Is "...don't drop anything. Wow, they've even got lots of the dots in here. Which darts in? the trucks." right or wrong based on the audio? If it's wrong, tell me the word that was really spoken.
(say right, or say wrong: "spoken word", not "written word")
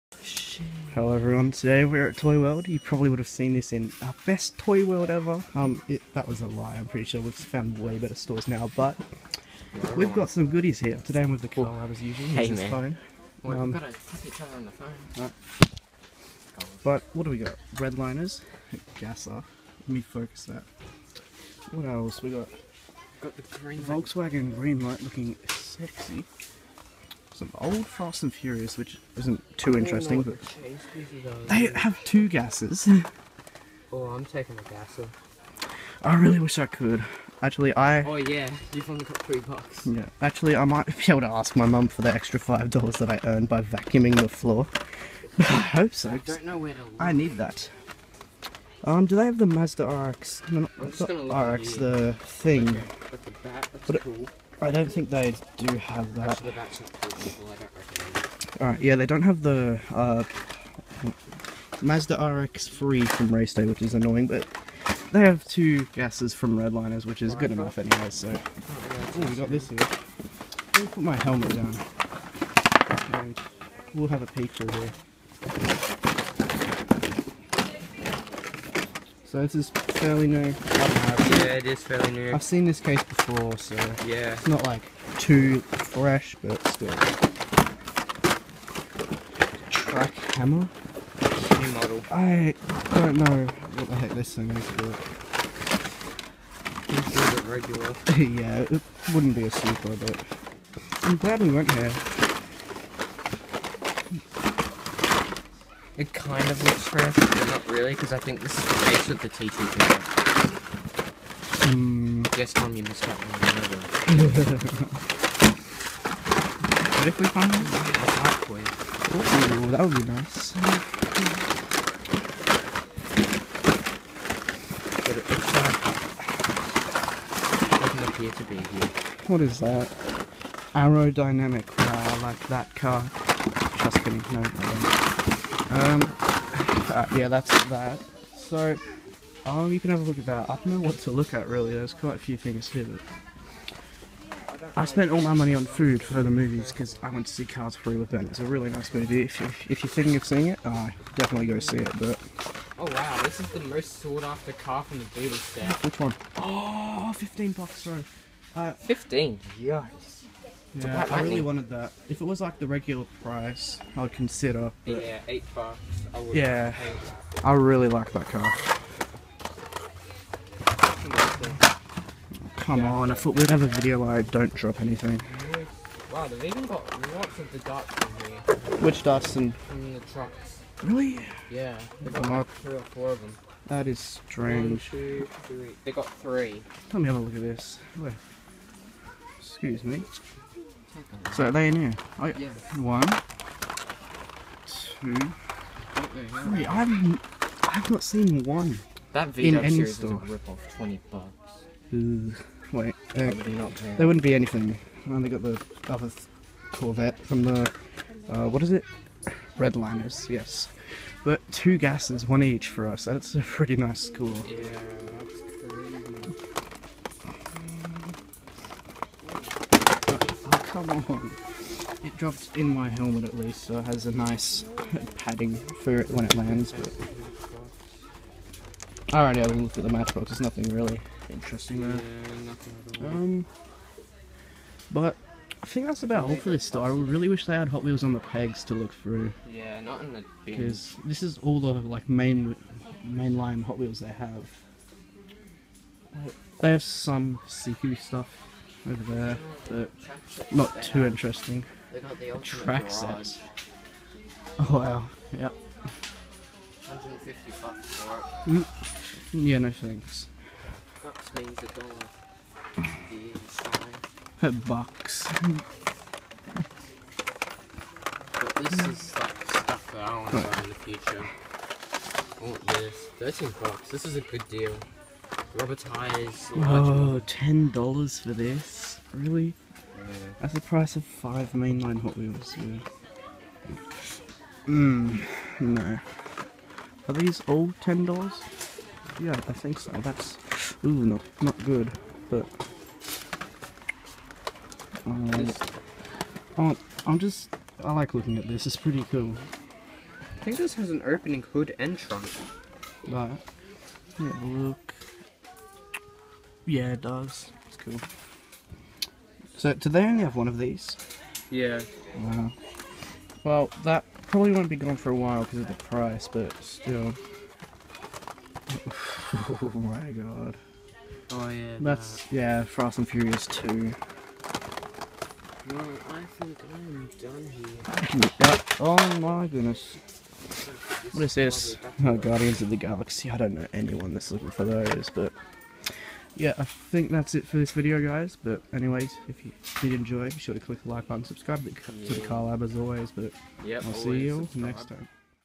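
right.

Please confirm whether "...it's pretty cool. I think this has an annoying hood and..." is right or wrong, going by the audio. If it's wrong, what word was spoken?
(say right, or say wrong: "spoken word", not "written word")
wrong: "opening", not "annoying".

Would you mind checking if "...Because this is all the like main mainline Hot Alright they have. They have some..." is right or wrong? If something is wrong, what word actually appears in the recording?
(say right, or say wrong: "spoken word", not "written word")
wrong: "Wheels", not "Alright".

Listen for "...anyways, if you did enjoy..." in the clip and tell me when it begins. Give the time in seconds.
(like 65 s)
338 s.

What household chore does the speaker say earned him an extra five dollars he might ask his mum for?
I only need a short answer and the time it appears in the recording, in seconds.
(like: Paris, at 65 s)
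Vacuuming the floor, at 43 s.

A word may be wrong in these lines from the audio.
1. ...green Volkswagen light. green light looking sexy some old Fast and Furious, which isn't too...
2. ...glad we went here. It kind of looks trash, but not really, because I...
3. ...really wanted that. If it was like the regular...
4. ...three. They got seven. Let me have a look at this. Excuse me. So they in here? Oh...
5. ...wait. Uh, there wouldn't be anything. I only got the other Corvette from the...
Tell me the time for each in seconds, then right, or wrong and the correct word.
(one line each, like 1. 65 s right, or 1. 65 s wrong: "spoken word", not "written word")
1. 23 s right
2. 101 s right
3. 161 s right
4. 185 s wrong: "three", not "seven"
5. 202 s right.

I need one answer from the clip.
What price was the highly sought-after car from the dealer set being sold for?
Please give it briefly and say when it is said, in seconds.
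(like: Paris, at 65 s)
$15, at 157 s.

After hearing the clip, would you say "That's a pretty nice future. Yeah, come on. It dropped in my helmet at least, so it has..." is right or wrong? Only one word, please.
wrong.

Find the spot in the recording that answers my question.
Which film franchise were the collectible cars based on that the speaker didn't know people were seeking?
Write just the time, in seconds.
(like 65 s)
332 s.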